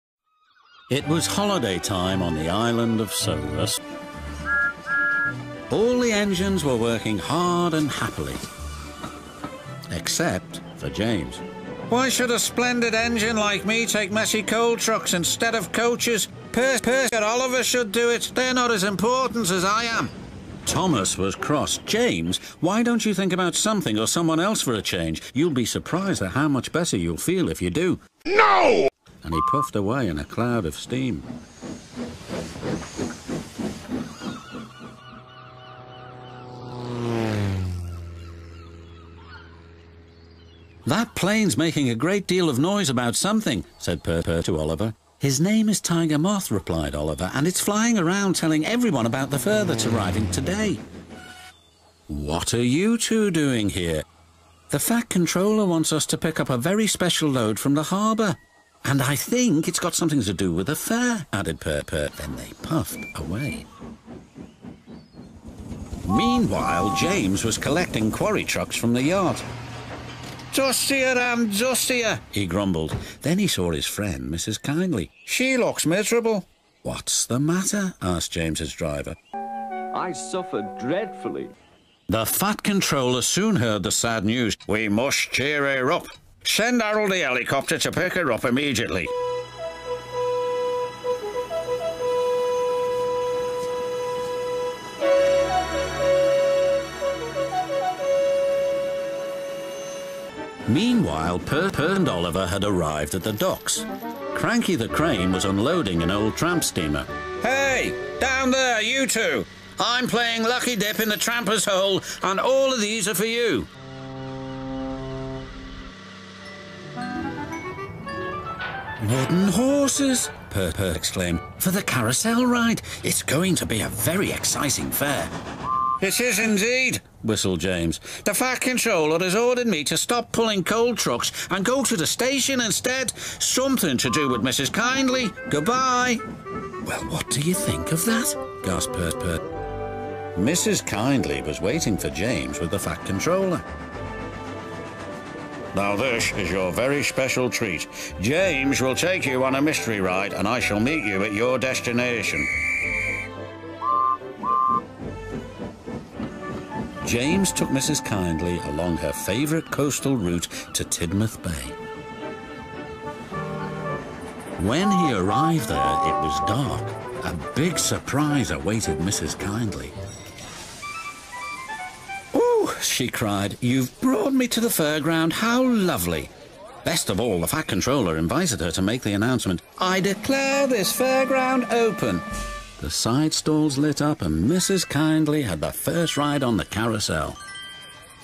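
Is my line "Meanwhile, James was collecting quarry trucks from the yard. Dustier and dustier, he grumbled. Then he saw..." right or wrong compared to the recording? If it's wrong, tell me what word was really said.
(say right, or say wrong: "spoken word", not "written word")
right.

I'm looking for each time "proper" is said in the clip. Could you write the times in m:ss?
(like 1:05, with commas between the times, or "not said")
not said.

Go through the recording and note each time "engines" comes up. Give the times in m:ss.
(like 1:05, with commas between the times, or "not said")
0:06, 0:12.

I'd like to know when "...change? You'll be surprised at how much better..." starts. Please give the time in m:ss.
0:24.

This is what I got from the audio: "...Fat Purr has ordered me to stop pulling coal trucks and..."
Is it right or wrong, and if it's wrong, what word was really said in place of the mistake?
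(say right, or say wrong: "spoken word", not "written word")
wrong: "Controller", not "Purr".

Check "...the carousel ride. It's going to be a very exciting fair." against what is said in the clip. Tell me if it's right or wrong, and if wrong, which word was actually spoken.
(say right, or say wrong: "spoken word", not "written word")
right.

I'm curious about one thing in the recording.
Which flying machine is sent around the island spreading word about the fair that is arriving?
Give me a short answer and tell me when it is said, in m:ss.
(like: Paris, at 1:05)
Tiger Moth, at 0:45.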